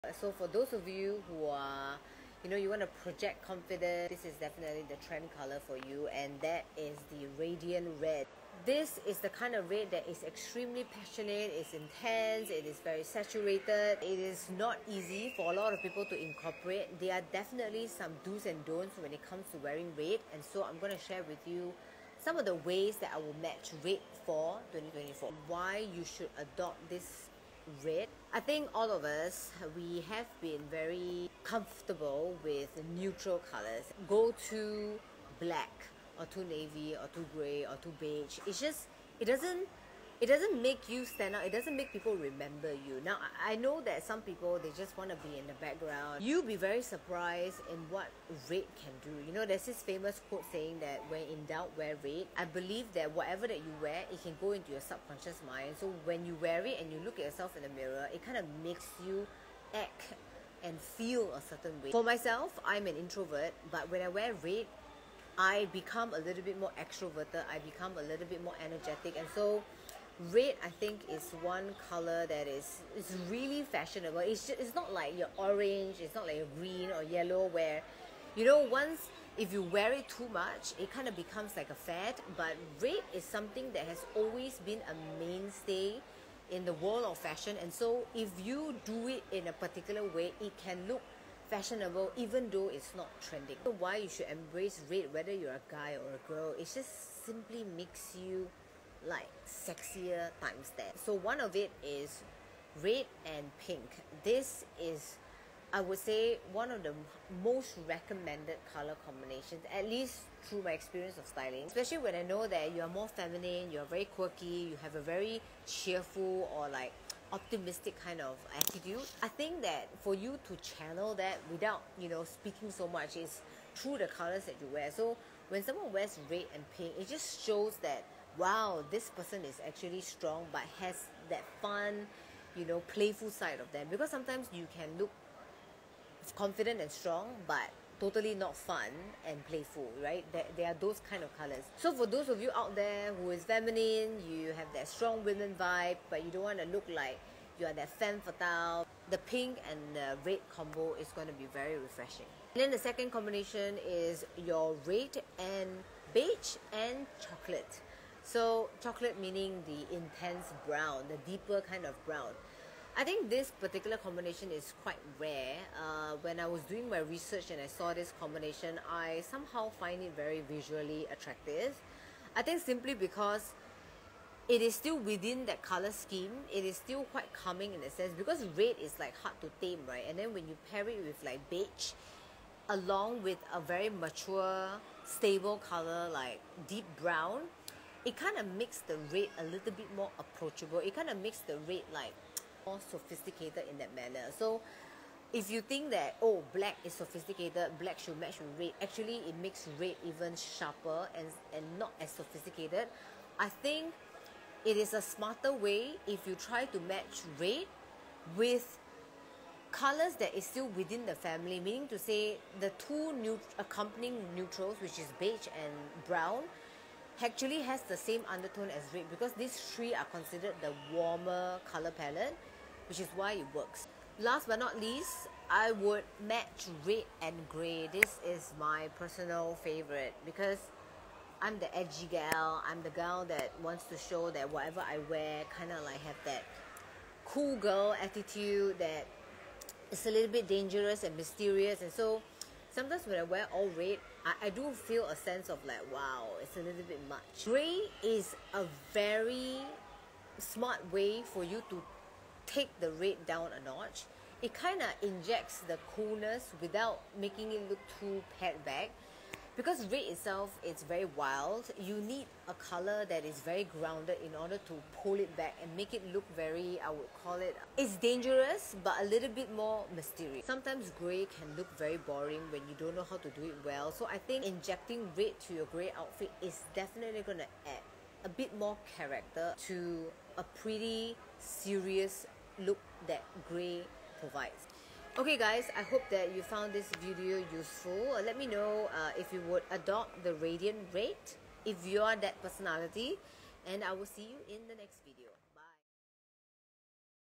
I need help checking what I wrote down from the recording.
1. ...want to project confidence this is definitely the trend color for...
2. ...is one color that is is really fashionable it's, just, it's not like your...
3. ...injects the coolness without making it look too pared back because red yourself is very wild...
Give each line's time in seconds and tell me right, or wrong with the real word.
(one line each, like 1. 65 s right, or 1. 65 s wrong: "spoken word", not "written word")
1. 2 s right
2. 71 s right
3. 255 s wrong: "itself", not "yourself".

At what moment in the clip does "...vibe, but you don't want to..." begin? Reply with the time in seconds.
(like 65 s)
145 s.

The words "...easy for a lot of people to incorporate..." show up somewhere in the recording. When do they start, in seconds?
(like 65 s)
14 s.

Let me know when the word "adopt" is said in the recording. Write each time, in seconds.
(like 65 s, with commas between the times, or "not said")
26 s, 289 s.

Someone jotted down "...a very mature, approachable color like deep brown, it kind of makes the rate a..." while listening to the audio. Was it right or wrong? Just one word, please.
wrong.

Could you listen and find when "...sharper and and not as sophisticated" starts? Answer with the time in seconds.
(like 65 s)
200 s.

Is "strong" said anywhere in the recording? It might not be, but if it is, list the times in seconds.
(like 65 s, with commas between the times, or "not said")
130 s, 136 s, 144 s.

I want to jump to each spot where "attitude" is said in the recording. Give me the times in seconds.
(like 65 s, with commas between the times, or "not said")
118 s, 238 s.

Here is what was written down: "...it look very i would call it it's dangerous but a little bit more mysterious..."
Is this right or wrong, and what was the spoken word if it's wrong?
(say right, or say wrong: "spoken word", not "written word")
right.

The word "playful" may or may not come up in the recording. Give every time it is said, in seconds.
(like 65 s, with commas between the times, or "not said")
132 s, 139 s.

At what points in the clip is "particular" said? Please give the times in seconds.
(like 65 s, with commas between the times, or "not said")
89 s, 163 s.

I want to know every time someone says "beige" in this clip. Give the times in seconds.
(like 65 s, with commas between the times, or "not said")
37 s, 156 s, 181 s, 215 s.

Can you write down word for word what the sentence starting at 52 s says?
I believe that whatever that you wear, it can go into your subconscious mind.